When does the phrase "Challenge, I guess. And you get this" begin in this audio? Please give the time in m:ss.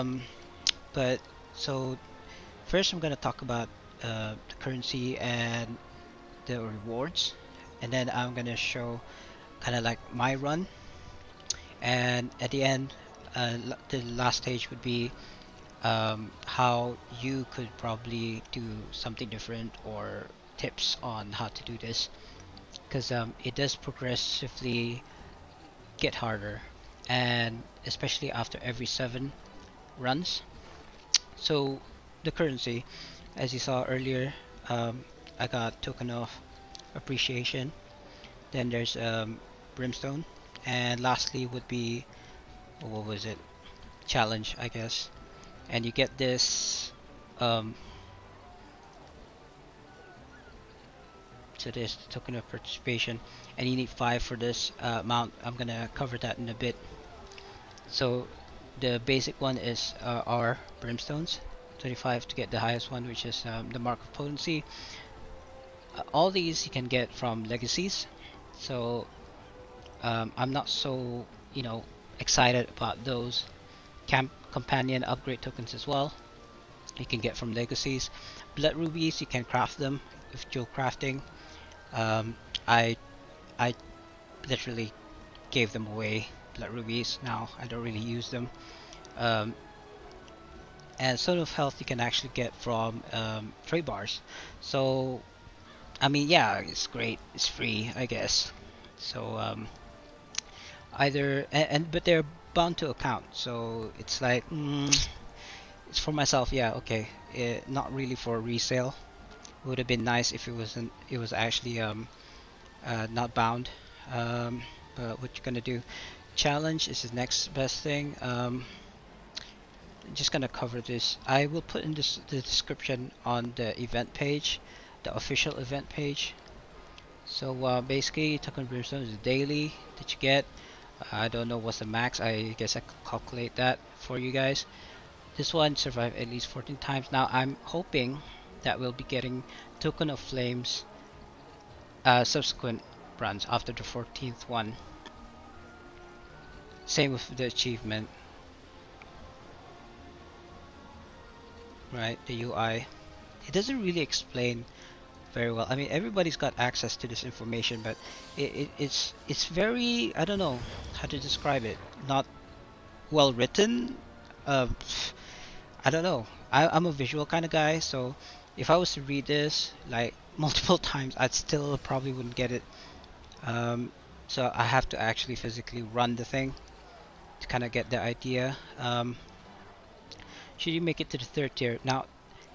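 0:44.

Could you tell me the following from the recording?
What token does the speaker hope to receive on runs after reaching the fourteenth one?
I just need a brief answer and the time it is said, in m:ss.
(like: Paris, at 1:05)
Token of Flames, at 2:19.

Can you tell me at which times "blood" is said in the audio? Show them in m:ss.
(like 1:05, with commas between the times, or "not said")
1:18, 1:26.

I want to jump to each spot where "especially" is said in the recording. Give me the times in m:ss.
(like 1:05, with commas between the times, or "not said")
0:27.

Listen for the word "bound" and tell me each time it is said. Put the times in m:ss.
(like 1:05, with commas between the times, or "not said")
1:42, 1:53.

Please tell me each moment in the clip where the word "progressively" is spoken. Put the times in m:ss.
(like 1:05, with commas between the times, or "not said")
0:23.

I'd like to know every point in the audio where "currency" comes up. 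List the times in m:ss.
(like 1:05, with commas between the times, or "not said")
0:04, 0:32.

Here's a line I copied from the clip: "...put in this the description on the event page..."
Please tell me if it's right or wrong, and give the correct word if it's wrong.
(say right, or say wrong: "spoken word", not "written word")
right.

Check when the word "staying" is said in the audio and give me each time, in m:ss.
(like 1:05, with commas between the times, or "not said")
not said.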